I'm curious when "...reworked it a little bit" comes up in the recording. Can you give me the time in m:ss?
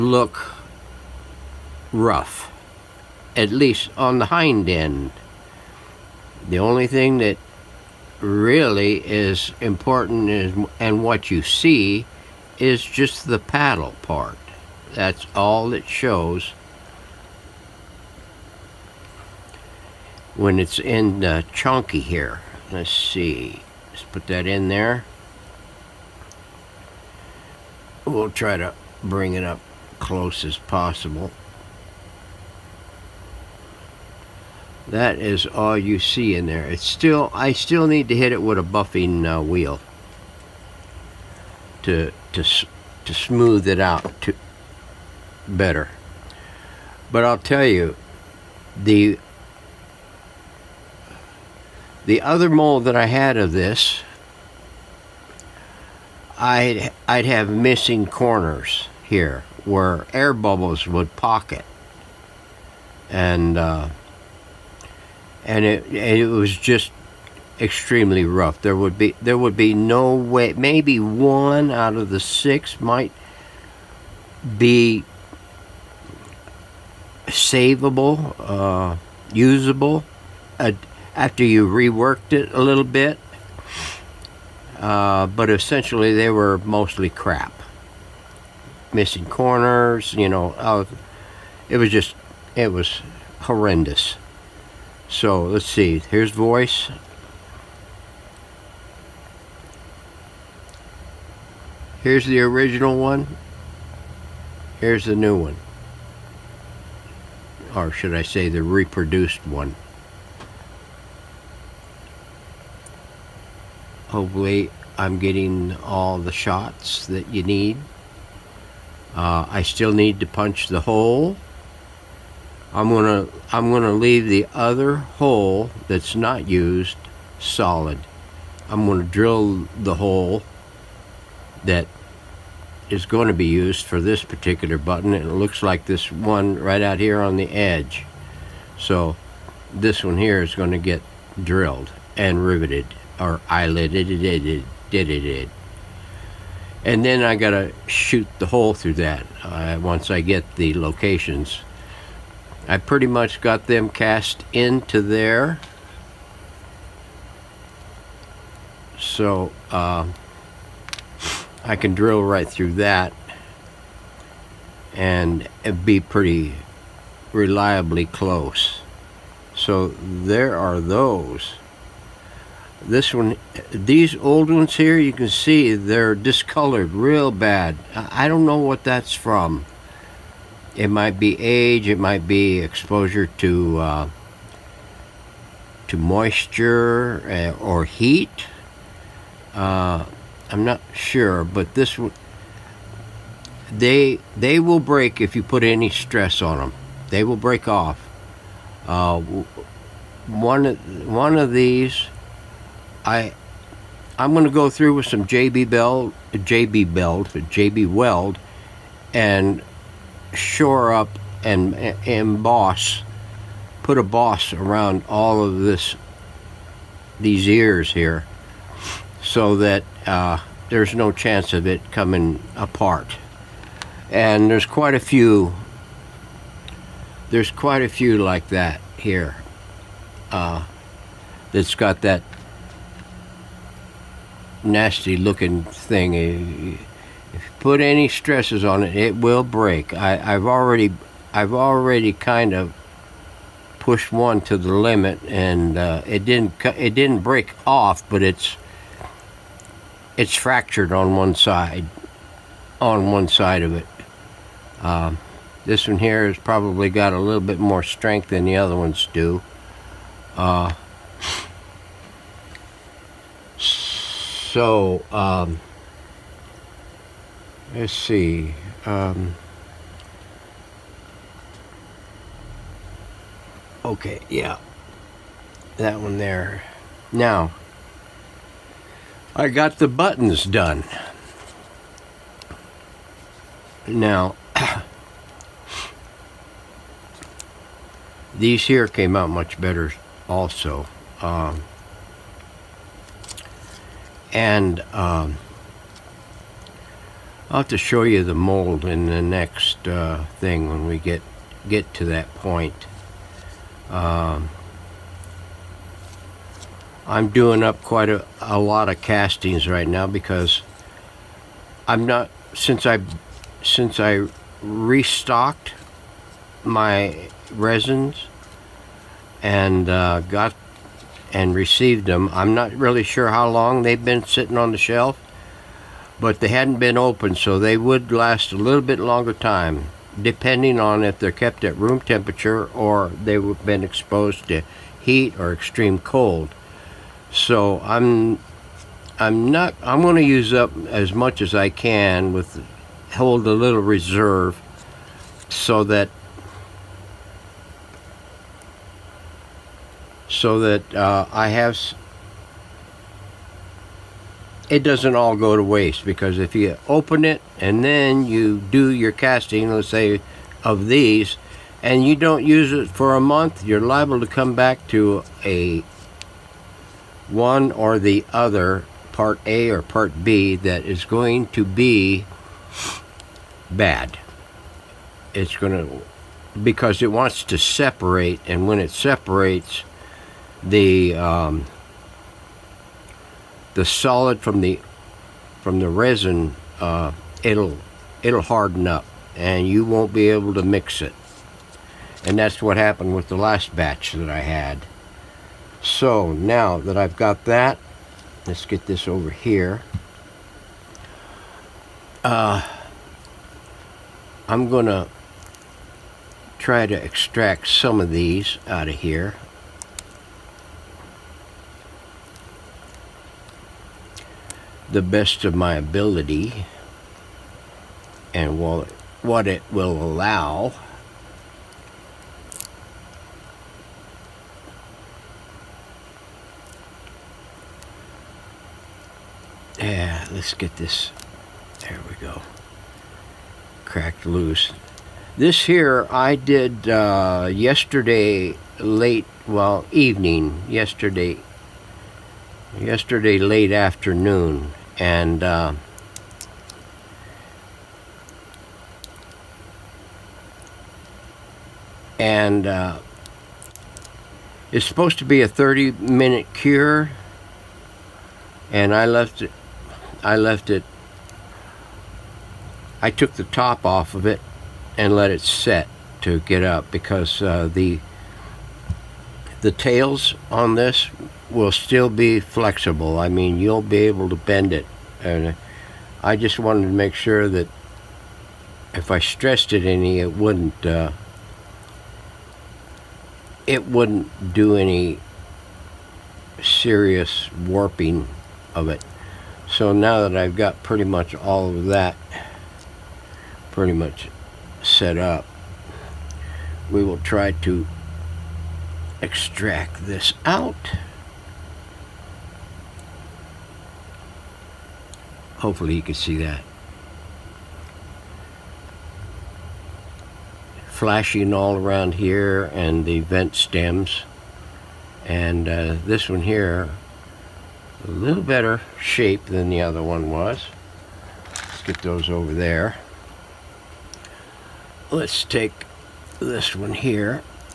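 1:21.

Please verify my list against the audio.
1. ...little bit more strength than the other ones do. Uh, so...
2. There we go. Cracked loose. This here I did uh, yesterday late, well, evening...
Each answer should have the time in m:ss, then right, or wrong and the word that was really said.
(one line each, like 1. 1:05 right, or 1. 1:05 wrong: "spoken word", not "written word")
1. 4:17 right
2. 7:11 right.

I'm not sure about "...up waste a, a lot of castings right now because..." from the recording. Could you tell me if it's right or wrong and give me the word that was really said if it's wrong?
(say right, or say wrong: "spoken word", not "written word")
wrong: "quite", not "waste".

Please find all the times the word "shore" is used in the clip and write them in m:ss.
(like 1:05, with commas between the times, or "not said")
3:30.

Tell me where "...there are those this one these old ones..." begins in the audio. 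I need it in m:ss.
2:50.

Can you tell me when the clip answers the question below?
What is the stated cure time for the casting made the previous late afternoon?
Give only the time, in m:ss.
7:35.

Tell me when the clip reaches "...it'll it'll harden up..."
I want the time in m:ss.
6:27.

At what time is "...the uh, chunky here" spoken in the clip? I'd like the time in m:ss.
0:21.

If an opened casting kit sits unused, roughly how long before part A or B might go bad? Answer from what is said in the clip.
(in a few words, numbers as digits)
a month.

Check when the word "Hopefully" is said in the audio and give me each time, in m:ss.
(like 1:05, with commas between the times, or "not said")
1:54, 8:25.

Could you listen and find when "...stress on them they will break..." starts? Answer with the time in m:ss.
3:15.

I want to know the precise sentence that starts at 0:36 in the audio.
It's still, I still need to hit it with a buffing uh, wheel to, to, to smooth it out to better.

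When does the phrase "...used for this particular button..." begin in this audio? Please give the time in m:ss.
2:13.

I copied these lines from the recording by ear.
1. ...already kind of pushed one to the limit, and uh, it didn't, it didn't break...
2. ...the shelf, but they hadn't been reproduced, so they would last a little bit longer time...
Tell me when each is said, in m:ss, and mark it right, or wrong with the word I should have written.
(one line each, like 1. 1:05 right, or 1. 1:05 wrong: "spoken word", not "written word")
1. 4:01 right
2. 5:24 wrong: "opened", not "reproduced".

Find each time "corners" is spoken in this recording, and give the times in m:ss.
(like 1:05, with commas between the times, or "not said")
0:58, 1:29.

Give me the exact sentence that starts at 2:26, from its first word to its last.
And then I got to shoot the hole through that uh, once I get the locations.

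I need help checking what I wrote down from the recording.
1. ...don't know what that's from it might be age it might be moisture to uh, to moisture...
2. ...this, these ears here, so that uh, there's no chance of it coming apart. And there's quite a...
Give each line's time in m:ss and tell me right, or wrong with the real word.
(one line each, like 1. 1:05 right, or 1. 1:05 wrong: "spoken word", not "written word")
1. 2:58 wrong: "exposure", not "moisture"
2. 3:35 right.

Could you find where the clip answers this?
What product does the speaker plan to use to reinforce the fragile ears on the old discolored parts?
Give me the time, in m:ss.
3:27.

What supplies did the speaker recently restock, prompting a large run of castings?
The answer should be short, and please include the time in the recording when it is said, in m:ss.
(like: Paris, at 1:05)
resins, at 5:17.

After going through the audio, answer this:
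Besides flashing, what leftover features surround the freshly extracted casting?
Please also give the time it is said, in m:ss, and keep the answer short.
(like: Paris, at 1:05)
vent stems, at 8:33.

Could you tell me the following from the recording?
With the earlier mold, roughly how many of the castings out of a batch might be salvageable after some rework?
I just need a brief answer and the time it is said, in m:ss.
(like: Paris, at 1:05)
1 out of 6, at 1:10.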